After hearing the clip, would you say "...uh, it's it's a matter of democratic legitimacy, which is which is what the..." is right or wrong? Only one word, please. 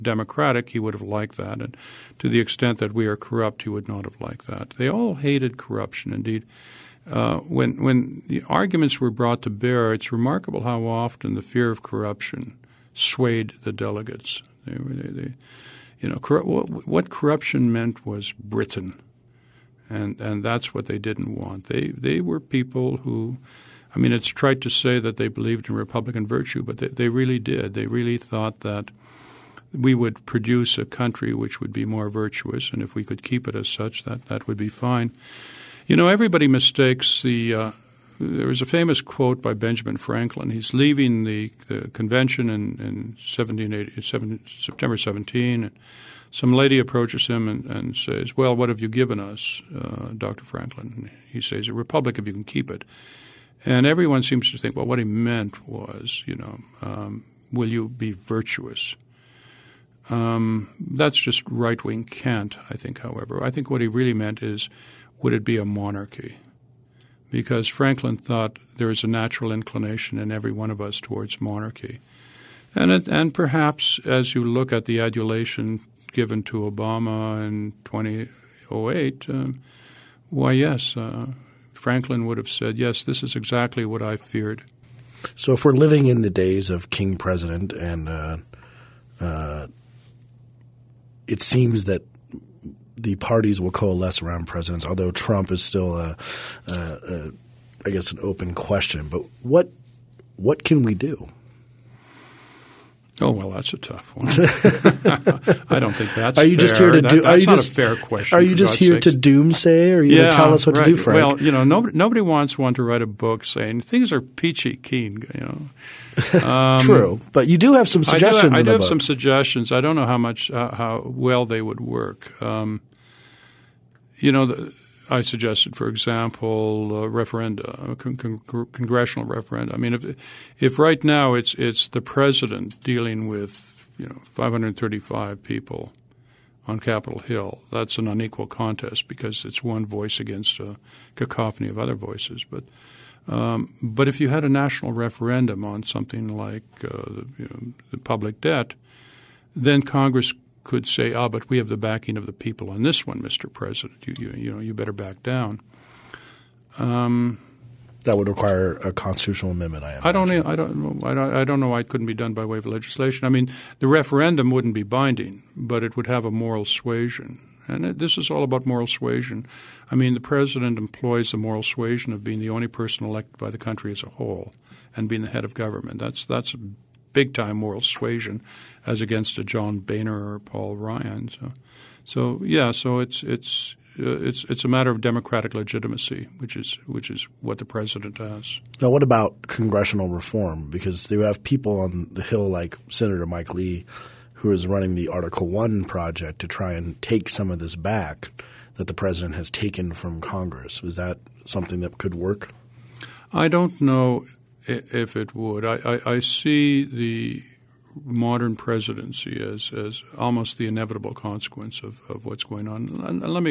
right.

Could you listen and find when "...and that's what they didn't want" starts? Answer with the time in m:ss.
0:20.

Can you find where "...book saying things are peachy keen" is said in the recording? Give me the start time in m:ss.
1:53.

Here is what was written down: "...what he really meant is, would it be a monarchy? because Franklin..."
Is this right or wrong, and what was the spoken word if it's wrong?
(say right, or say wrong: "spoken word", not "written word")
right.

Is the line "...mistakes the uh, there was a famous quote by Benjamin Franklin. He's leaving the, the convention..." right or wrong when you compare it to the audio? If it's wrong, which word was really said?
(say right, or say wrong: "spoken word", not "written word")
right.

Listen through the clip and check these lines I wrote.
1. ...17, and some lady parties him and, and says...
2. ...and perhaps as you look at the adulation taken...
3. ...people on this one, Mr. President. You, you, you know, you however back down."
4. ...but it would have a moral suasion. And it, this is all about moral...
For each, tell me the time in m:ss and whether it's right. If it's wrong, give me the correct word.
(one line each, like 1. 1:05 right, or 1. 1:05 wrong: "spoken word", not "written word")
1. 0:44 wrong: "approaches", not "parties"
2. 1:13 wrong: "given", not "taken"
3. 2:32 wrong: "better", not "however"
4. 2:45 right.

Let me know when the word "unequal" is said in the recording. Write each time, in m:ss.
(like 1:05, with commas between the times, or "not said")
2:18.